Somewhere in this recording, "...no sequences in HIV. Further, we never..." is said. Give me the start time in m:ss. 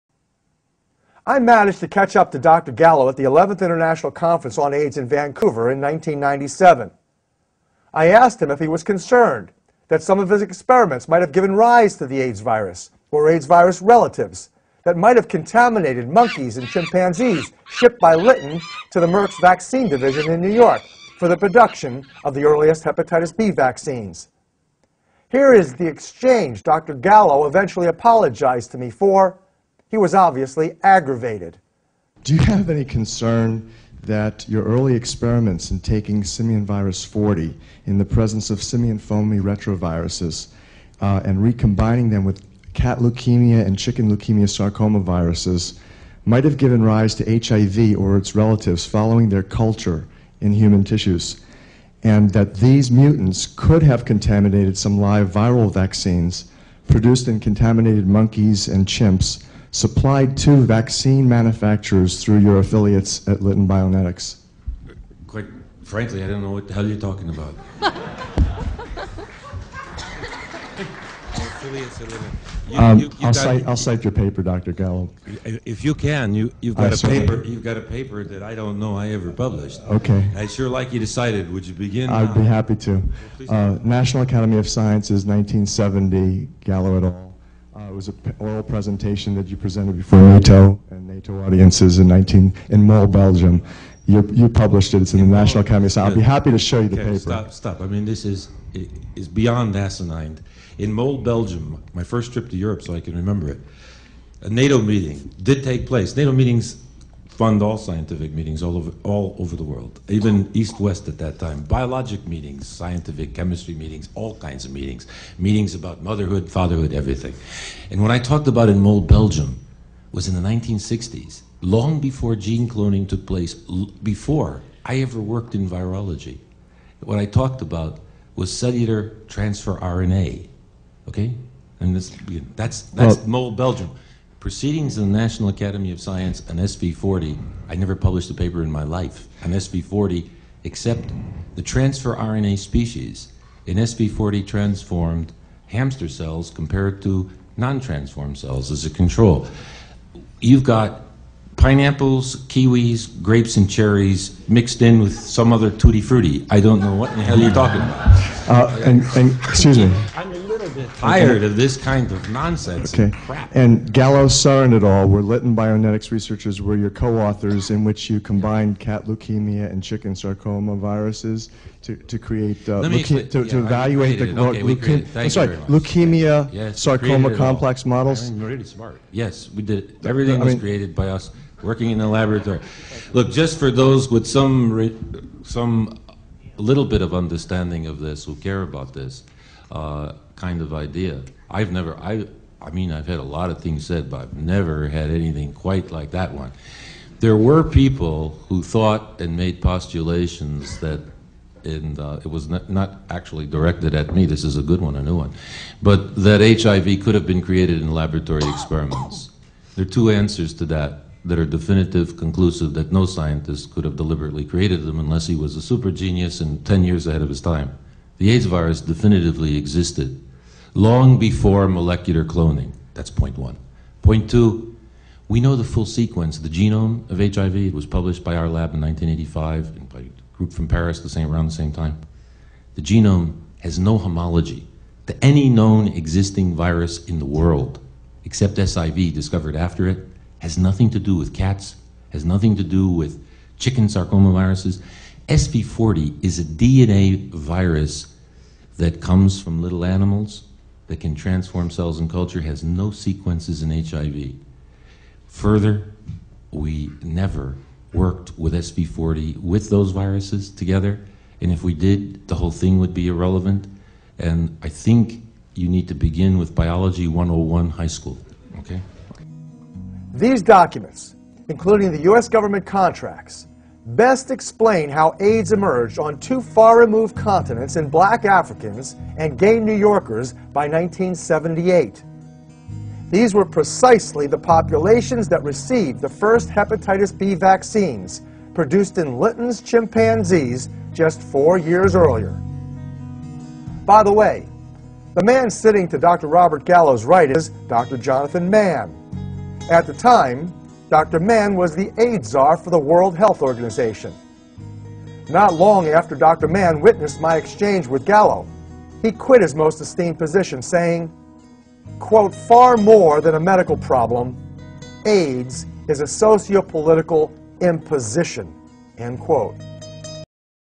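4:12.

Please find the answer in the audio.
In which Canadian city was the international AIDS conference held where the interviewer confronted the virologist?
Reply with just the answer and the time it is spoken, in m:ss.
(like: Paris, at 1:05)
Vancouver, at 0:05.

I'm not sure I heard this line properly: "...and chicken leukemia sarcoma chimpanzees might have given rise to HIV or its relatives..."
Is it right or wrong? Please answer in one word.
wrong.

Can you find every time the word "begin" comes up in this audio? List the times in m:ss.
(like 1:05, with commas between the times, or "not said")
1:21, 4:25.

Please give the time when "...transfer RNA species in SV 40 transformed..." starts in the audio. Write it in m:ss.
2:21.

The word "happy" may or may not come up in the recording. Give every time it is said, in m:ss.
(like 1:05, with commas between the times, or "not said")
1:22, 1:36.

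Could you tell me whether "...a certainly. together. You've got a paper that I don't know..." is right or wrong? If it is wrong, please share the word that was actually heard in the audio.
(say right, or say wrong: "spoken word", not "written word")
wrong: "paper", not "together".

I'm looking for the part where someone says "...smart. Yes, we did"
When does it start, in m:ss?
2:58.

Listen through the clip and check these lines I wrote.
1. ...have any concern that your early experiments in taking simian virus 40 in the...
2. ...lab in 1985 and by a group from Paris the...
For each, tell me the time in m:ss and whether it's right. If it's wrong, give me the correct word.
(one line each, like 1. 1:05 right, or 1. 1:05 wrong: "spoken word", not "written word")
1. 0:32 right
2. 3:48 right.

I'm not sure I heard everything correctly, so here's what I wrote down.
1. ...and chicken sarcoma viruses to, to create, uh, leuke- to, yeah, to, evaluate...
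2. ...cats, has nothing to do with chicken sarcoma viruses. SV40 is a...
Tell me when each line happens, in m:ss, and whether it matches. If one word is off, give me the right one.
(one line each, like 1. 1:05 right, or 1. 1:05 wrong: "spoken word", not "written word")
1. 2:49 right
2. 4:01 right.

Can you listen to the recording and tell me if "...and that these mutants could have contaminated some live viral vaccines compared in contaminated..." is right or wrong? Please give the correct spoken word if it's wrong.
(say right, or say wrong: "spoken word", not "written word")
wrong: "produced", not "compared".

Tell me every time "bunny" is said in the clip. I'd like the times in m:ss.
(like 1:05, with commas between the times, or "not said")
not said.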